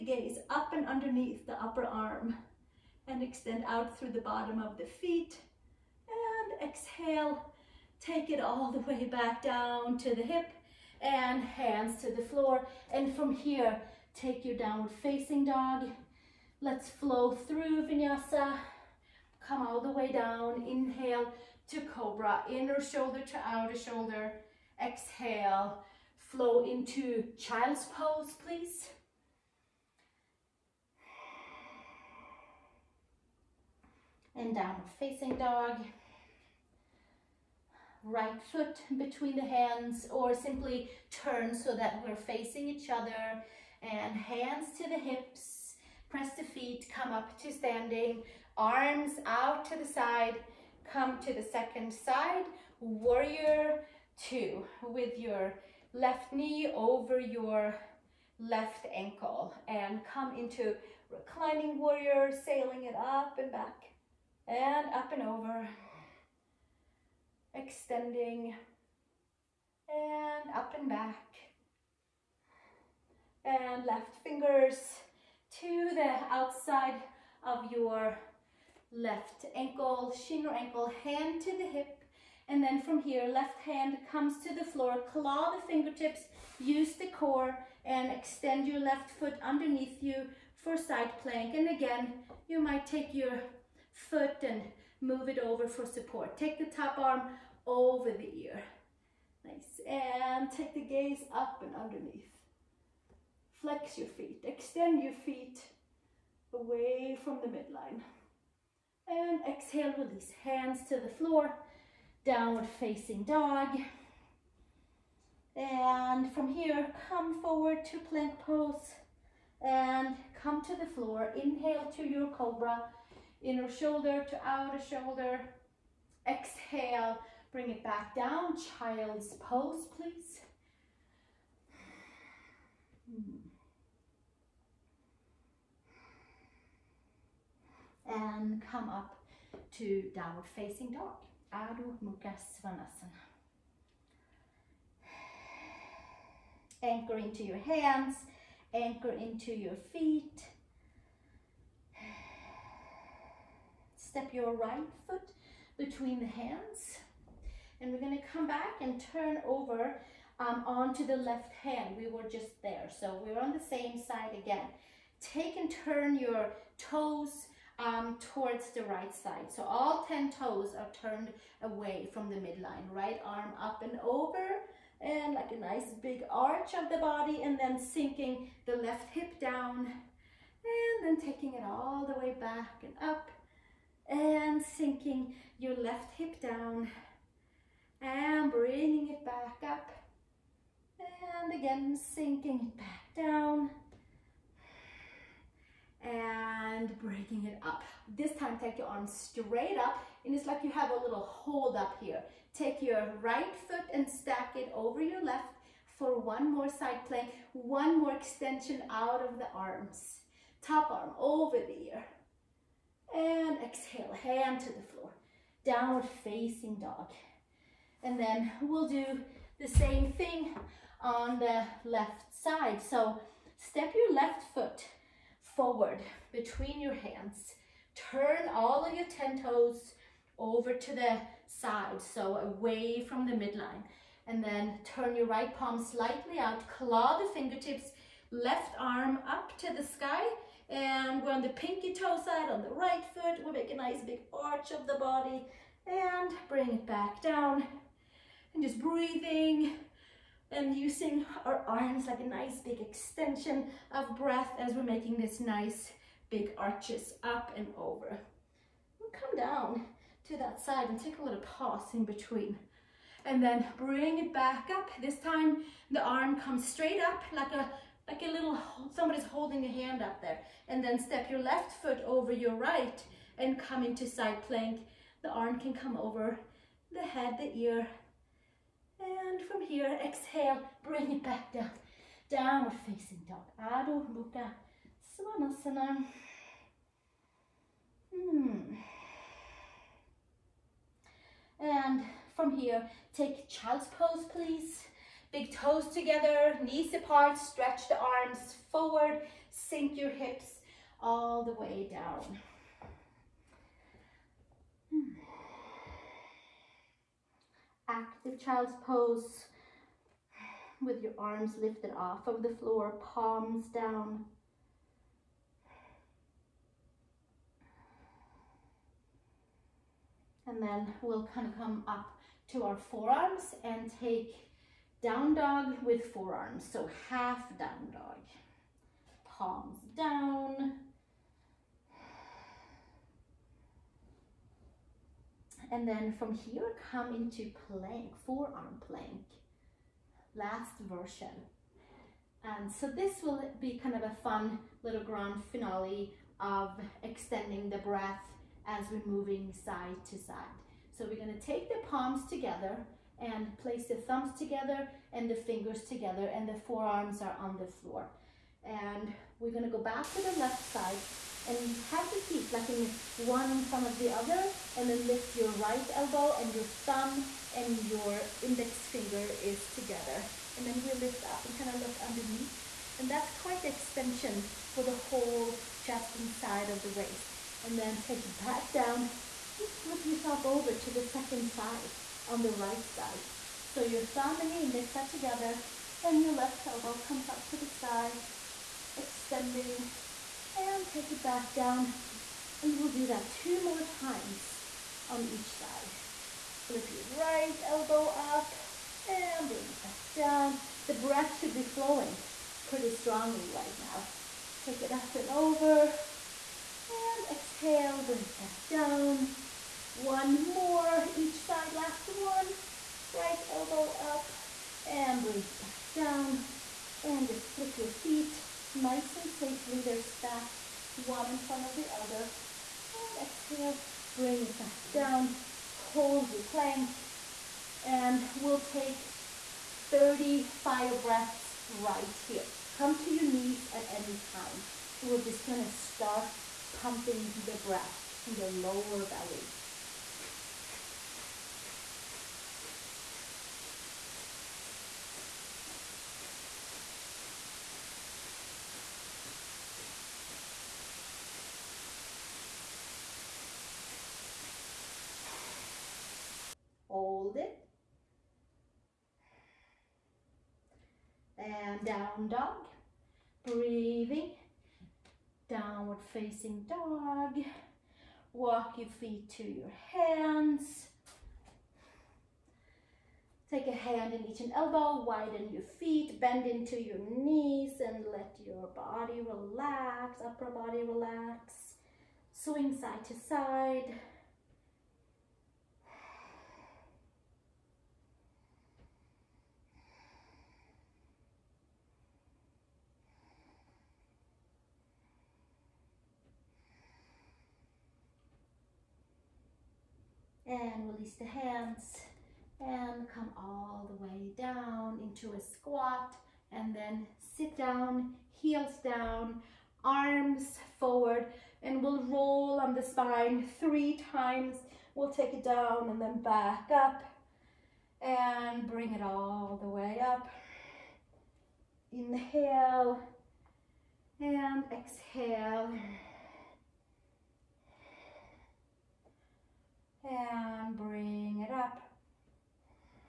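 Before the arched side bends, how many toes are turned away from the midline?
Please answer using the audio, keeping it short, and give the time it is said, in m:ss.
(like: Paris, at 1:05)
10, at 2:49.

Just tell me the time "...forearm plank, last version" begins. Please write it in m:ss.
5:38.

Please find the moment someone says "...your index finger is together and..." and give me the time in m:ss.
6:07.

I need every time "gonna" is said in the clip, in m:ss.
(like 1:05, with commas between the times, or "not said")
2:38, 5:51, 5:59, 7:15.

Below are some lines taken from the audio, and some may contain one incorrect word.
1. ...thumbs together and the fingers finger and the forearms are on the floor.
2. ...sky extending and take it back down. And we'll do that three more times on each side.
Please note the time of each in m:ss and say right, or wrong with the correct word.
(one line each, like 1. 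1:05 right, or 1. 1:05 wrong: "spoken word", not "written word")
1. 5:53 wrong: "together", not "finger"
2. 6:27 wrong: "two", not "three".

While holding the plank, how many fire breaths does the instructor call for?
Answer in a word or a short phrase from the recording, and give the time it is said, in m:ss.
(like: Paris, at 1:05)
30, at 7:09.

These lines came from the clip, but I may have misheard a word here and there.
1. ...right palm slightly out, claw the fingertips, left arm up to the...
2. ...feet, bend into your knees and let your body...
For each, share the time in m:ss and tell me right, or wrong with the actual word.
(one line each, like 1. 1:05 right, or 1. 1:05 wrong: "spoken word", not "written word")
1. 3:55 right
2. 7:55 right.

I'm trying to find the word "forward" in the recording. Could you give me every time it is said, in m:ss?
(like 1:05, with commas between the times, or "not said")
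1:57, 3:45, 4:58, 8:30.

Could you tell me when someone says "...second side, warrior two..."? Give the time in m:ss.
0:51.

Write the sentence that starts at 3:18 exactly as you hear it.
This time take your arms straight up and it's like you have a little hold up here.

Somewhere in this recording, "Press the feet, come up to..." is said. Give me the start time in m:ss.
0:46.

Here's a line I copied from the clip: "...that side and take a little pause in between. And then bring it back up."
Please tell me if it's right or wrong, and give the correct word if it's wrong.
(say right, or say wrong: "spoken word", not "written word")
right.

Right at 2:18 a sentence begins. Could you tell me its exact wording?
And come up to downward facing dog.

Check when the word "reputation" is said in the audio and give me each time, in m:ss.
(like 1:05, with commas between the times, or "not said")
not said.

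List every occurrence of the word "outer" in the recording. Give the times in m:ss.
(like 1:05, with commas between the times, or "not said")
0:23, 2:04.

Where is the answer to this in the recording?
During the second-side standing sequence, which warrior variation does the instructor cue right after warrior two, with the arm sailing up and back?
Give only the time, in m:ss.
1:01.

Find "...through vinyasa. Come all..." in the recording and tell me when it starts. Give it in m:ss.
0:17.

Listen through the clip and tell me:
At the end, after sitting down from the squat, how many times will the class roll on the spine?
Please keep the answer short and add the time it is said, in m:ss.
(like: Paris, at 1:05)
3, at 8:33.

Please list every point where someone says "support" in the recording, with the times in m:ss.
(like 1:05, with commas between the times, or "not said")
1:35.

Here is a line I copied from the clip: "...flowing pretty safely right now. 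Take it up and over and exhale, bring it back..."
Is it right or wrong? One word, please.
wrong.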